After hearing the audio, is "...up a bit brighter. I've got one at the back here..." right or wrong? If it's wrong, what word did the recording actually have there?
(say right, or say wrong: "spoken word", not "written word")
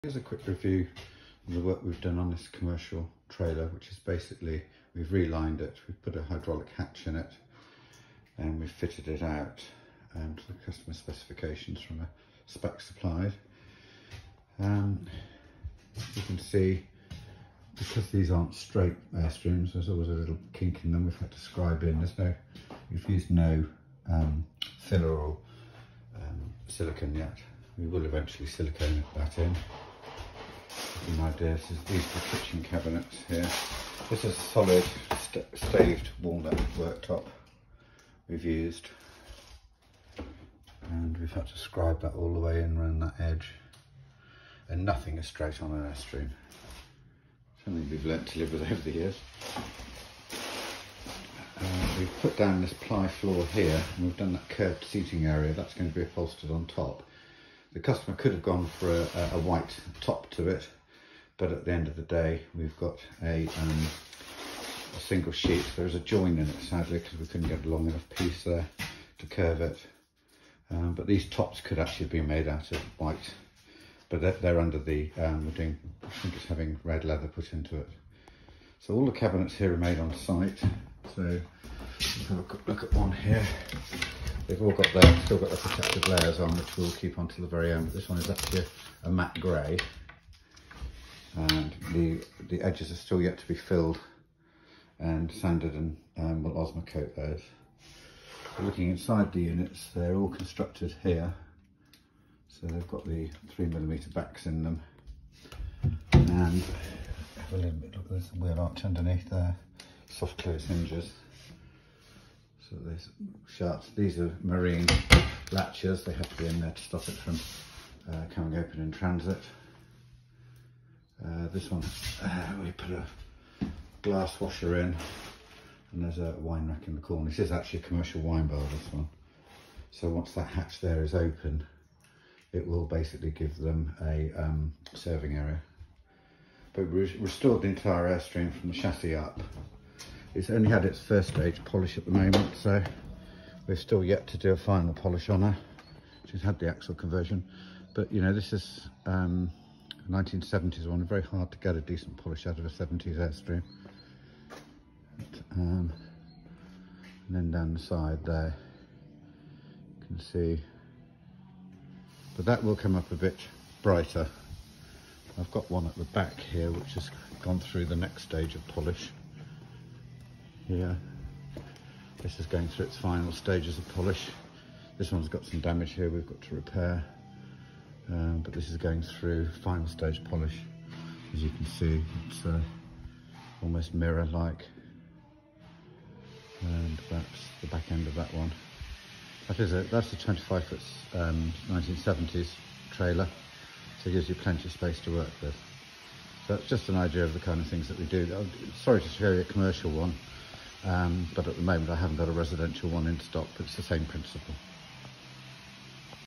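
right.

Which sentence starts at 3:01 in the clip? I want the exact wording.
As you can see, it's uh, almost mirror-like.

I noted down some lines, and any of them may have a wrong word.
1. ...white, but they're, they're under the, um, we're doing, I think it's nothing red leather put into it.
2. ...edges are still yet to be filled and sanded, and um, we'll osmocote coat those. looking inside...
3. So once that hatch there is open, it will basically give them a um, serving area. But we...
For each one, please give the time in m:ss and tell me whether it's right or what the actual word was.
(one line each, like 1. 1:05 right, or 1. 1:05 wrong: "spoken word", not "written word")
1. 1:12 wrong: "having", not "nothing"
2. 1:32 right
3. 2:09 right.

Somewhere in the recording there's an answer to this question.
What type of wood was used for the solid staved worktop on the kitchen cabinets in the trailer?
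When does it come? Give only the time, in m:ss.
0:36.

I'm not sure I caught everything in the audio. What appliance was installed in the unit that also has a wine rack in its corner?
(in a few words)
Glass washer.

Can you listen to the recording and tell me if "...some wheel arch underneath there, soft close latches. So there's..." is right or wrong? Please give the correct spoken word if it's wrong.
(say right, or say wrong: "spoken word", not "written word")
wrong: "hinges", not "latches".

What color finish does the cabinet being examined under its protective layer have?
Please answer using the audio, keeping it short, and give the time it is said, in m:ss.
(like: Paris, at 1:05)
Matte grey, at 1:29.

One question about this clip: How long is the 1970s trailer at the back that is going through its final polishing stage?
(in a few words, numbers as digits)
25 foot.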